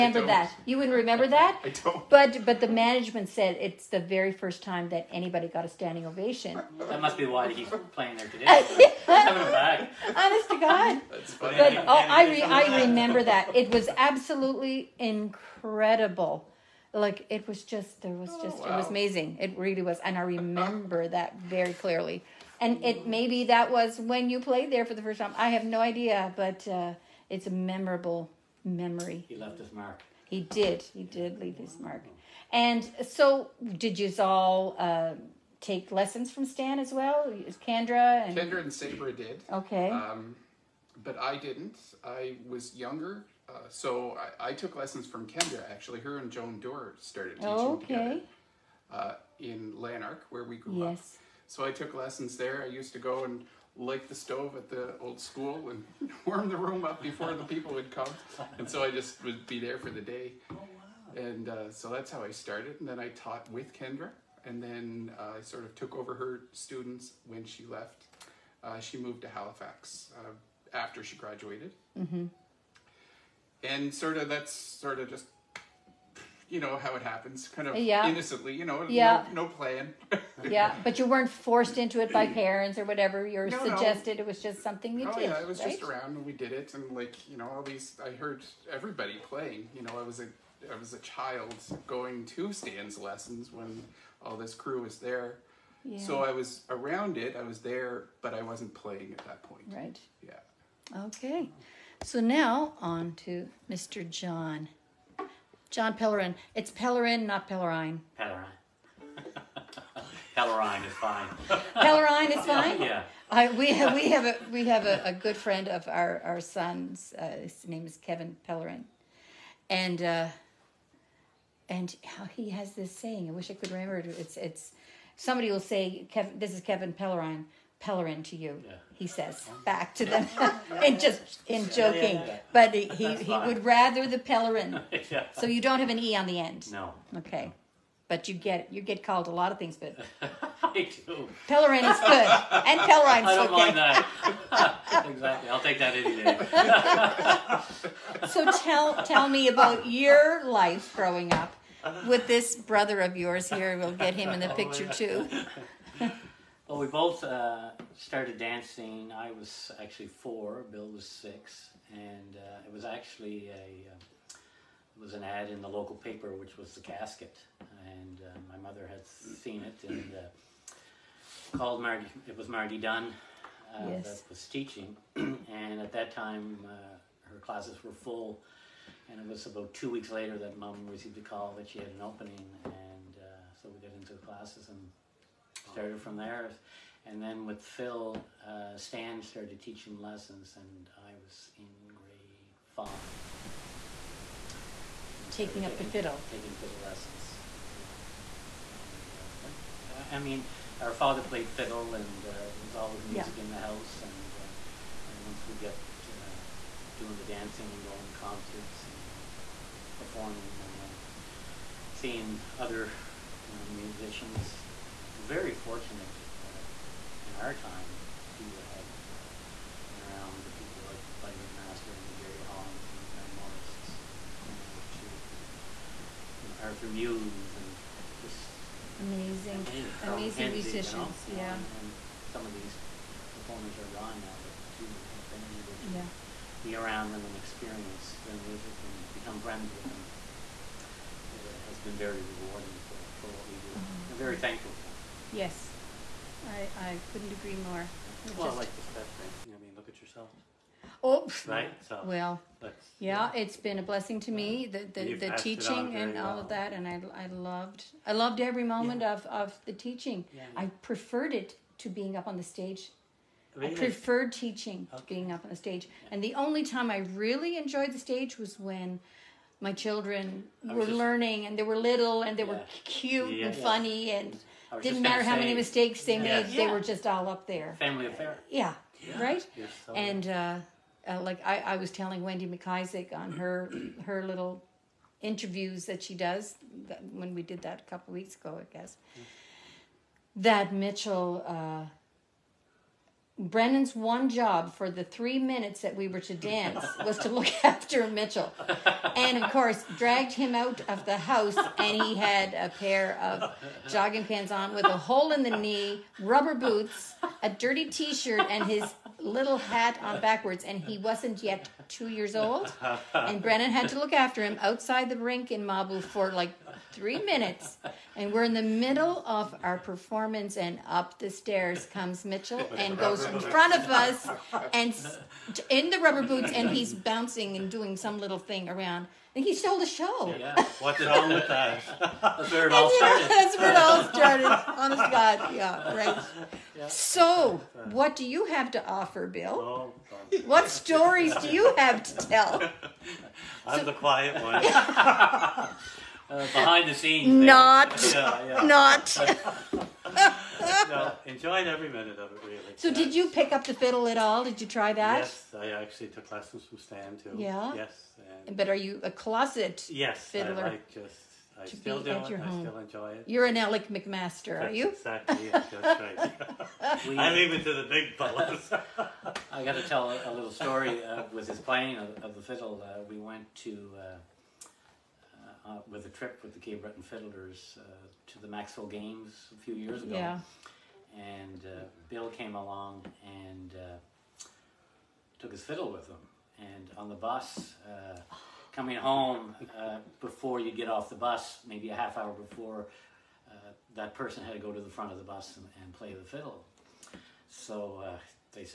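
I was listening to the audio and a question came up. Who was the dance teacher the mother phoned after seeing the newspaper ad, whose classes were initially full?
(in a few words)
Margie Dunn.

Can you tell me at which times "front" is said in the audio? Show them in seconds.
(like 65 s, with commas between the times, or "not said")
323 s, 394 s.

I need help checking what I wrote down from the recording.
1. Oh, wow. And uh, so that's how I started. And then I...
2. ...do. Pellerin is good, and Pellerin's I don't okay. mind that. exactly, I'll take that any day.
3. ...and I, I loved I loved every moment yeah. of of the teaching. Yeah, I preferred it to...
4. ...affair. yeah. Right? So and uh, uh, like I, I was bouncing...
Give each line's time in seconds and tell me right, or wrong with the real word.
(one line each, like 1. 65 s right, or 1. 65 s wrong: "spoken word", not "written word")
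1. 60 s right
2. 141 s right
3. 256 s right
4. 278 s wrong: "telling", not "bouncing".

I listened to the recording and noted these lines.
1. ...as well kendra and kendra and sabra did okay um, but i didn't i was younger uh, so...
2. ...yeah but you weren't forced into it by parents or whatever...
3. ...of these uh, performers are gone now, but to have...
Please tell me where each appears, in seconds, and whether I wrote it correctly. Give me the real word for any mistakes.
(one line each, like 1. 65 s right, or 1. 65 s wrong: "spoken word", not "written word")
1. 36 s right
2. 80 s right
3. 232 s right.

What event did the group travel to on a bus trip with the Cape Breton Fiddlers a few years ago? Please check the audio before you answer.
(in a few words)
Maxville Games.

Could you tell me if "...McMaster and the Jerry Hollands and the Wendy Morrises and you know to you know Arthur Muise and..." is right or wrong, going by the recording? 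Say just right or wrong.
wrong.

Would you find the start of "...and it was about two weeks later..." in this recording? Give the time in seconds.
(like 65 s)
179 s.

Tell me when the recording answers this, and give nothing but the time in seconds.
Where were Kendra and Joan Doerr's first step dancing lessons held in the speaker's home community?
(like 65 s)
49 s.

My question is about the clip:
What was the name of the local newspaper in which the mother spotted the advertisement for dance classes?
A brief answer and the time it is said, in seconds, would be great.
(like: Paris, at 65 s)
The Casket, at 166 s.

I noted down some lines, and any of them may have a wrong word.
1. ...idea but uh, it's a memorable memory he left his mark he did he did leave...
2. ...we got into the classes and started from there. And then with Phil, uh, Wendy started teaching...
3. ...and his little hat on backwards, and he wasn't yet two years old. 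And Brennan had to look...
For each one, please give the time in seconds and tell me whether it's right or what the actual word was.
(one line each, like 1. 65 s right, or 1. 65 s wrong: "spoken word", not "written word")
1. 25 s right
2. 183 s wrong: "Stan", not "Wendy"
3. 308 s right.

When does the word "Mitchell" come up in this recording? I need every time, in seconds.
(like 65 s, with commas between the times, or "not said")
290 s, 298 s, 322 s.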